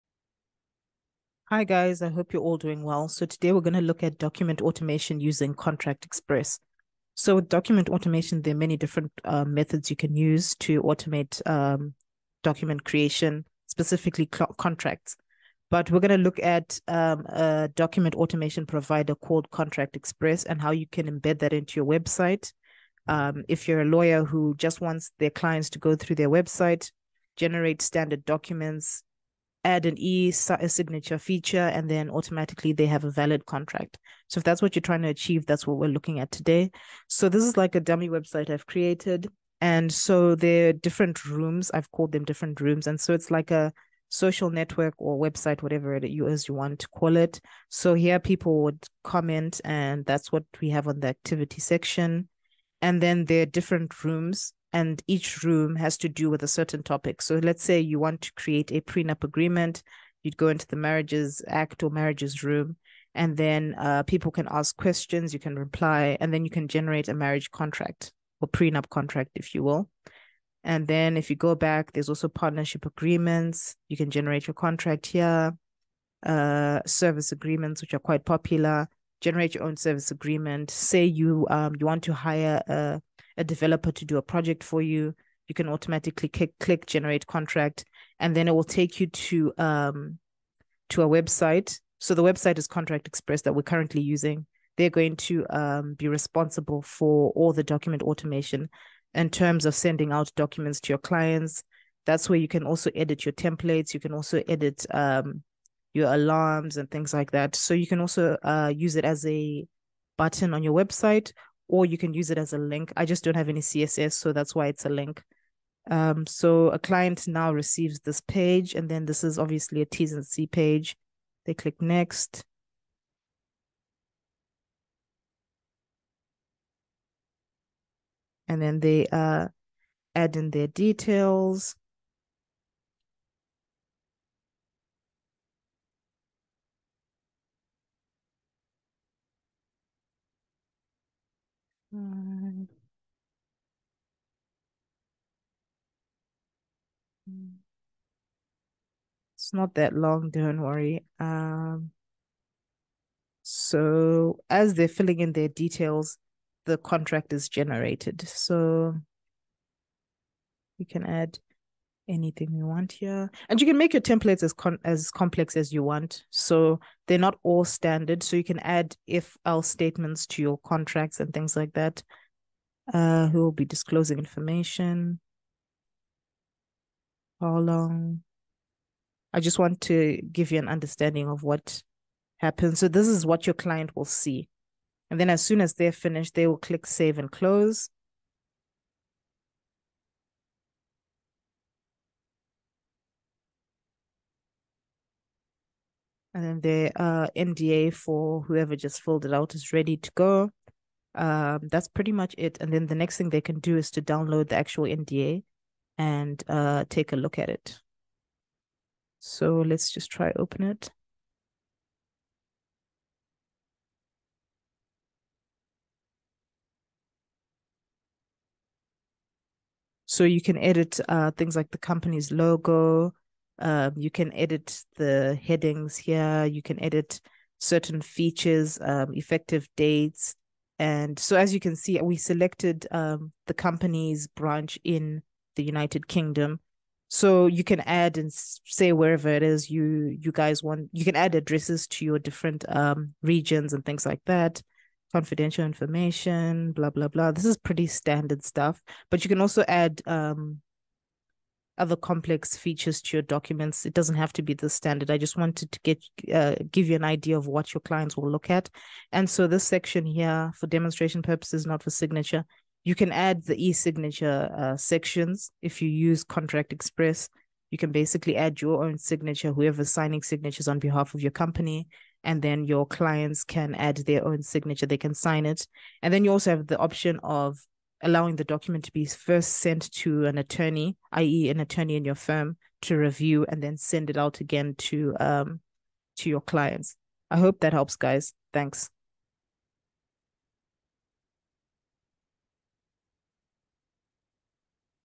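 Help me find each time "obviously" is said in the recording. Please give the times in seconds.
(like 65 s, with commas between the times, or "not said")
119 s.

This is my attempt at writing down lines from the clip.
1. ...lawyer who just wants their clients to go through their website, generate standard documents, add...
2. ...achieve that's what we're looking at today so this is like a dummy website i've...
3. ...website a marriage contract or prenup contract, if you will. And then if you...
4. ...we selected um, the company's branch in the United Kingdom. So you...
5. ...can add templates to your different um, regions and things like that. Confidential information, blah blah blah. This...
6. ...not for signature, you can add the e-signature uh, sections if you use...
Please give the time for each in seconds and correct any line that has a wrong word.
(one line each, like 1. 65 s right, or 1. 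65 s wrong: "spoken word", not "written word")
1. 23 s right
2. 35 s right
3. 66 s wrong: "generate", not "website"
4. 232 s right
5. 241 s wrong: "addresses", not "templates"
6. 261 s right.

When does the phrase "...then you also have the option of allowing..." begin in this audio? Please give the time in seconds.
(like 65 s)
276 s.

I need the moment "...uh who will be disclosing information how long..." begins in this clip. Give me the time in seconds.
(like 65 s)
172 s.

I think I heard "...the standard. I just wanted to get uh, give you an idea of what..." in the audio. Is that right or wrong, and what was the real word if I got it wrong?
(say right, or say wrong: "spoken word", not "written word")
right.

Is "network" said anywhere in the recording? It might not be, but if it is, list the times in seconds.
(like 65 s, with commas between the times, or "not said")
44 s.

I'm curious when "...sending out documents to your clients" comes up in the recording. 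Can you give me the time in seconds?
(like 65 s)
99 s.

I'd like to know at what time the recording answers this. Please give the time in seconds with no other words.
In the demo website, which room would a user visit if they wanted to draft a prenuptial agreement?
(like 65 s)
61 s.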